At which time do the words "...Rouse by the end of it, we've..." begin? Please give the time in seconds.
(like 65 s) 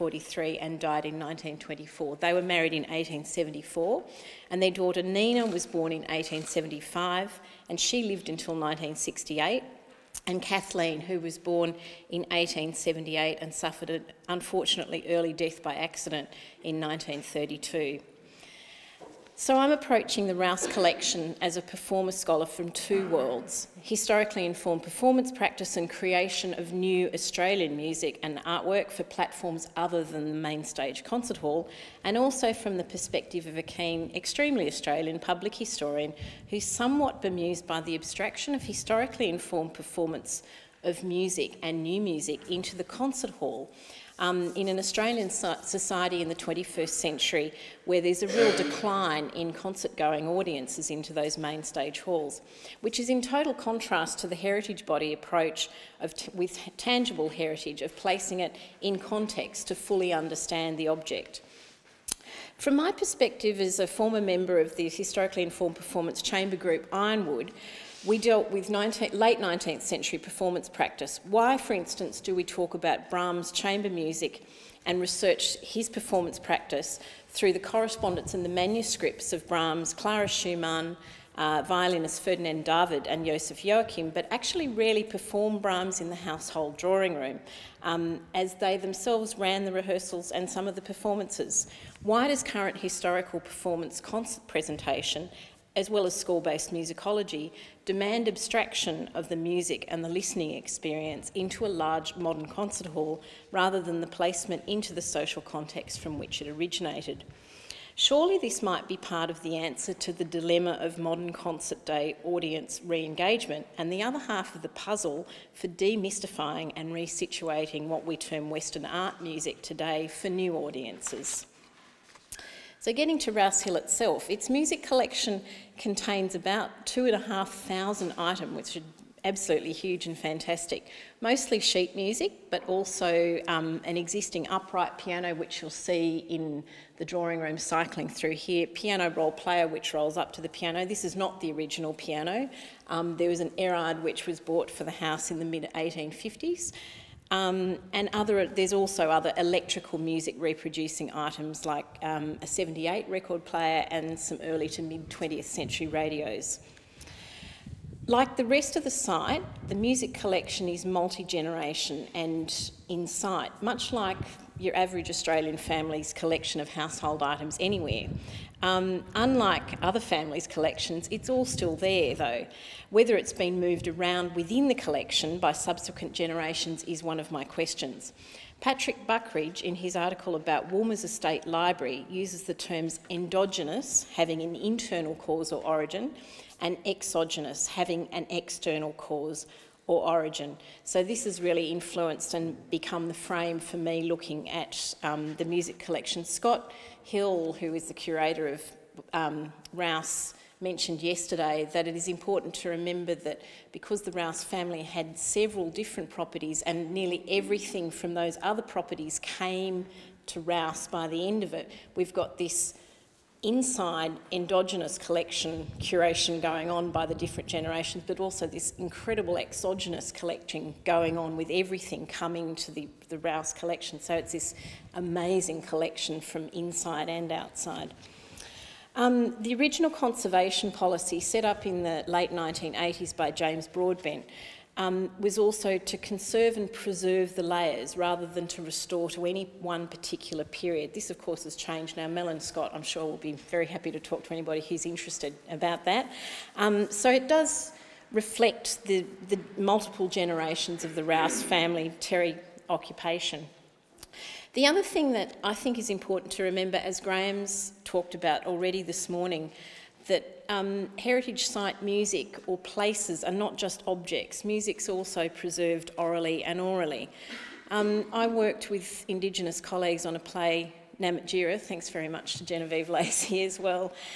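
210 s.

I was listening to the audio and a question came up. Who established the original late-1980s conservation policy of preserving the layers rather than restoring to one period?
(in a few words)
James Broadbent.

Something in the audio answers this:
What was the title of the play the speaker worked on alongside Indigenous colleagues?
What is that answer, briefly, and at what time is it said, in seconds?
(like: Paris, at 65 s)
Namatjira, at 270 s.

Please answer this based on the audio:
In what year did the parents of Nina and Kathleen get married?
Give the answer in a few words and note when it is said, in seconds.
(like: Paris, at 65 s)
1874, at 2 s.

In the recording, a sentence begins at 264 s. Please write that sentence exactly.
Music's also preserved orally and aurally.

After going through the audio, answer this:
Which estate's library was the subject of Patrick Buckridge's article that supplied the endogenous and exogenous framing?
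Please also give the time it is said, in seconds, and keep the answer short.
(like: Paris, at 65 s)
Woolmer's Estate, at 180 s.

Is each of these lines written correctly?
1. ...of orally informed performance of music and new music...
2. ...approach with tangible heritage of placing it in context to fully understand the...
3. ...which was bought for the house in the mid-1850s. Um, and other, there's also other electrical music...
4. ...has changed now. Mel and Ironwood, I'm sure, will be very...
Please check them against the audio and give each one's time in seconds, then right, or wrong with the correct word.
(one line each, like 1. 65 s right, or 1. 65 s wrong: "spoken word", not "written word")
1. 38 s wrong: "historically", not "orally"
2. 55 s right
3. 144 s right
4. 241 s wrong: "Scott", not "Ironwood".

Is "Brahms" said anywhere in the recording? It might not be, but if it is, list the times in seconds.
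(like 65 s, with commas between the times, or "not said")
73 s, 79 s, 85 s.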